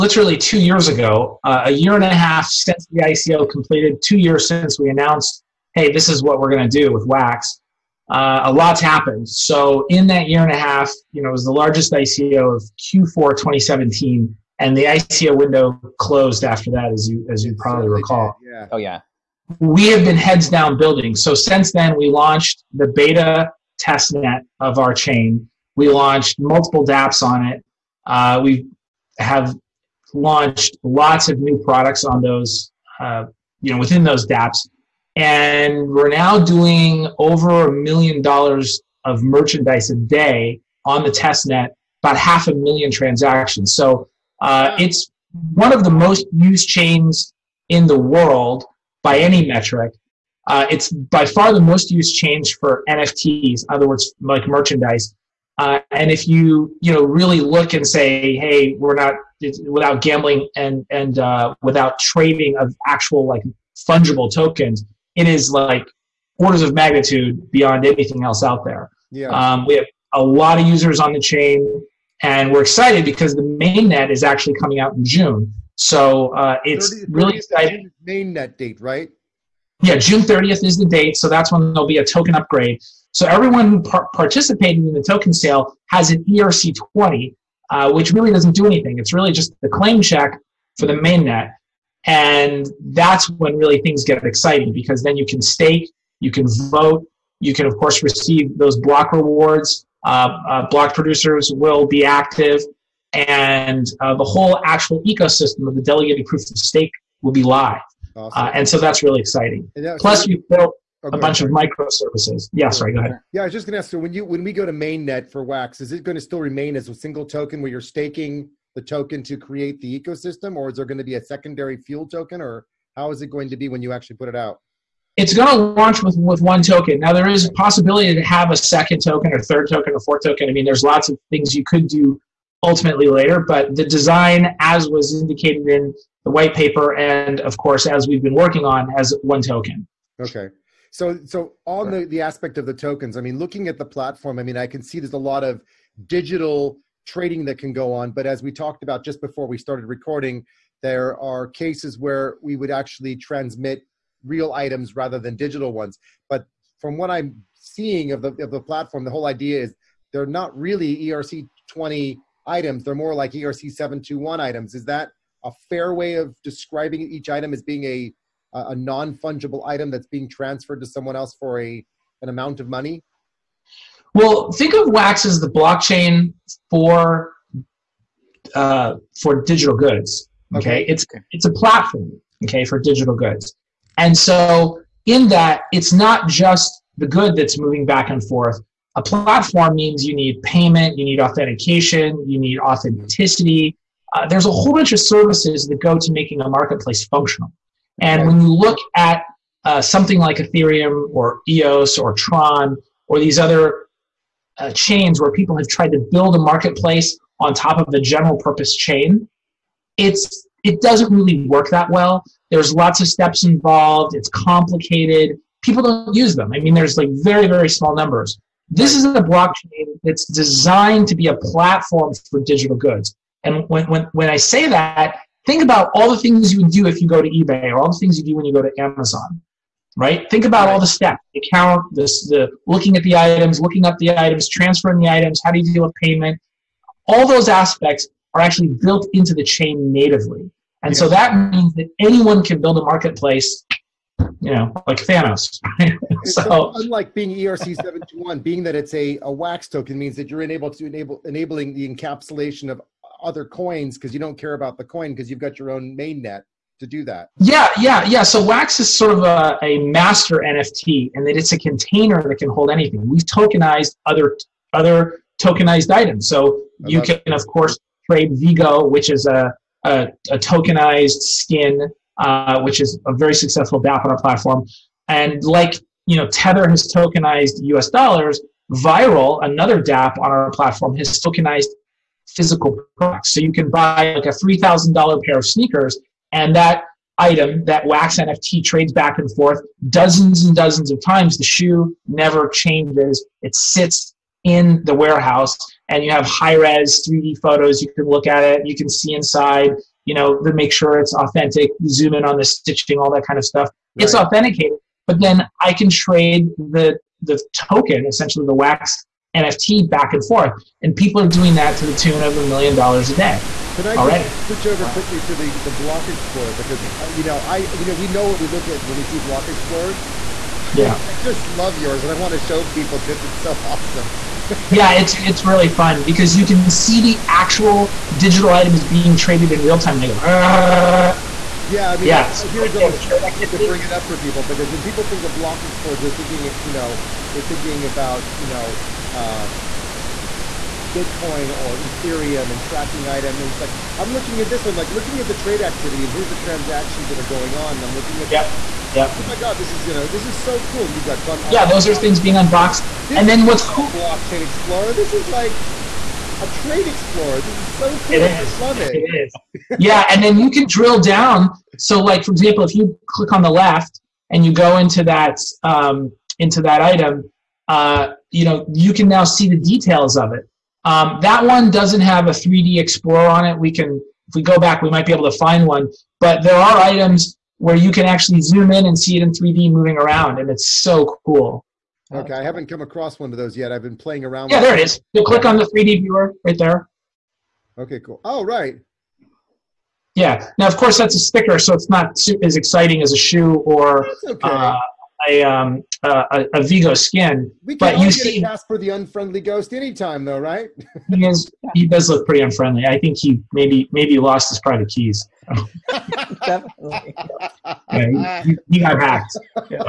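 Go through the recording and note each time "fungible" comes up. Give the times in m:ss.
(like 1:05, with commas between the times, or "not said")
1:03, 2:49.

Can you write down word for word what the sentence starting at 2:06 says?
Now, there is a possibility to have a second token or third token or fourth token.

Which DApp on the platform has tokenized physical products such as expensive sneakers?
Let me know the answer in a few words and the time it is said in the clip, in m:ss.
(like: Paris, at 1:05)
Viral, at 4:38.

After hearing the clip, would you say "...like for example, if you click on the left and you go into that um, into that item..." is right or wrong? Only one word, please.
right.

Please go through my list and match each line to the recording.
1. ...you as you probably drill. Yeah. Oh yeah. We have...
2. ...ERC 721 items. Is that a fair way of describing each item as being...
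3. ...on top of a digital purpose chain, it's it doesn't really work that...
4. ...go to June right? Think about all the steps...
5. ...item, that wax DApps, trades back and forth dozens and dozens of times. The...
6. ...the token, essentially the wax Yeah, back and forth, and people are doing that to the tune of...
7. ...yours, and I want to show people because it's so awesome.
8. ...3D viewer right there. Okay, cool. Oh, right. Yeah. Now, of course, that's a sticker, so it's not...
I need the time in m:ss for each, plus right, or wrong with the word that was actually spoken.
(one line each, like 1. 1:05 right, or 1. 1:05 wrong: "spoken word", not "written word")
1. 0:17 wrong: "recall", not "drill"
2. 2:43 right
3. 3:27 wrong: "general", not "digital"
4. 3:48 wrong: "Amazon", not "June"
5. 4:47 wrong: "NFT", not "DApps"
6. 5:07 wrong: "NFT", not "Yeah"
7. 5:21 right
8. 6:25 right.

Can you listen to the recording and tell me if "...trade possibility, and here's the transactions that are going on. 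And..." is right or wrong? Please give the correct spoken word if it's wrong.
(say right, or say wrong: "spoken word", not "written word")
wrong: "activity", not "possibility".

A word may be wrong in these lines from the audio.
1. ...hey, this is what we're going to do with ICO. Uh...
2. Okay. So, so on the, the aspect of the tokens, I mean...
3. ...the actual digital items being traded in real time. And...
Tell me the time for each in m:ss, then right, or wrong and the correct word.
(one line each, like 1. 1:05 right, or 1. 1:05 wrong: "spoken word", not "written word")
1. 0:05 wrong: "Wax", not "ICO"
2. 2:20 right
3. 5:26 right.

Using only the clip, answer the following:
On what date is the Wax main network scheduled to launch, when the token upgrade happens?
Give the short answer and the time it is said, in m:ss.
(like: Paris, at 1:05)
June 30th, at 1:19.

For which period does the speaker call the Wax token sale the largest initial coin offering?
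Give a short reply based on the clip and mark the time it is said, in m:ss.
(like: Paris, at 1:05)
Q4 2017, at 0:12.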